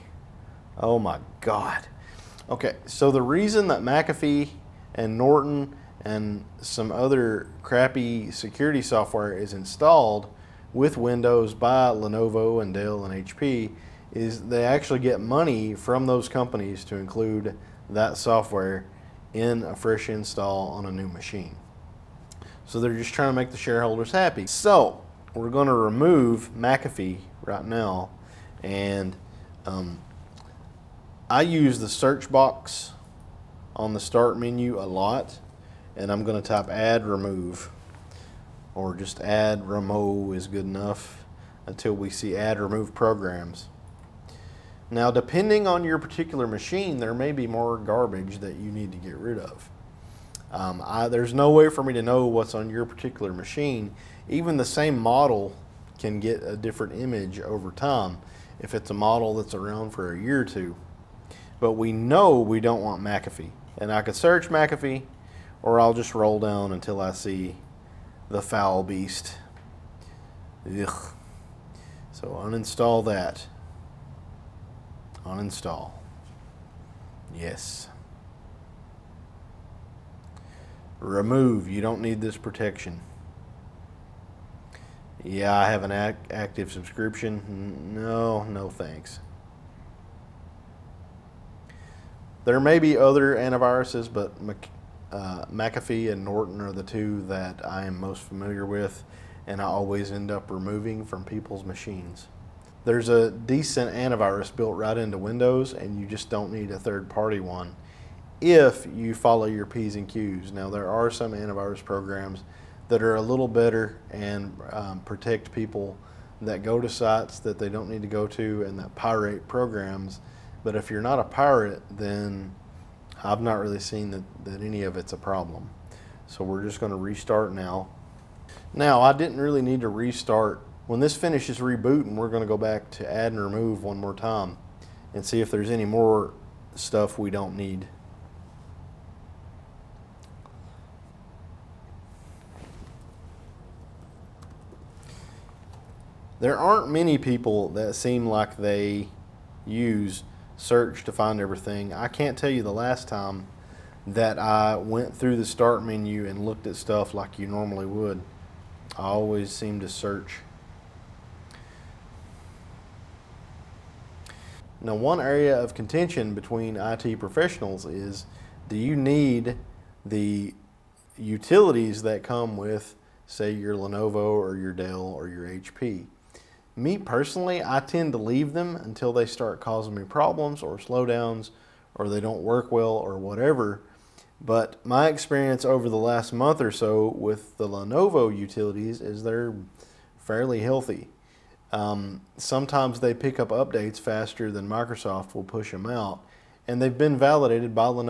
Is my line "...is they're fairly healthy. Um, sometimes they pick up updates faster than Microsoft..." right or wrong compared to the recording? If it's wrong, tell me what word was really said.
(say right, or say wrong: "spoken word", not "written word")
right.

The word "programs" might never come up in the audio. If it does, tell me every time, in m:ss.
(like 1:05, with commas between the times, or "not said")
0:42, 1:51, 1:59.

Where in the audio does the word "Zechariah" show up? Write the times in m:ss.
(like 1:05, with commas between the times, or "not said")
not said.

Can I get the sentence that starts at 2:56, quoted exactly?
me personally, I tend to leave them until they start causing me problems or slowdowns or they don't work well or whatever.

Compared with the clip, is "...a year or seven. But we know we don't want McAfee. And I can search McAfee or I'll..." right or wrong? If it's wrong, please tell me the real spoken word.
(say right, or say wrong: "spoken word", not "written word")
wrong: "two", not "seven".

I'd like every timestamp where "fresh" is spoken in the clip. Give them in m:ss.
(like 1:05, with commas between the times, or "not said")
0:19.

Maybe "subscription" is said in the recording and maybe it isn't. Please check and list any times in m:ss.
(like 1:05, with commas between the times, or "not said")
1:26.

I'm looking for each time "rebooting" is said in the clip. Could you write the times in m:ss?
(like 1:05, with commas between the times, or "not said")
2:11.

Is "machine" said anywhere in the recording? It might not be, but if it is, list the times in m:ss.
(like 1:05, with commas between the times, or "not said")
0:21, 0:46, 0:53, 1:41.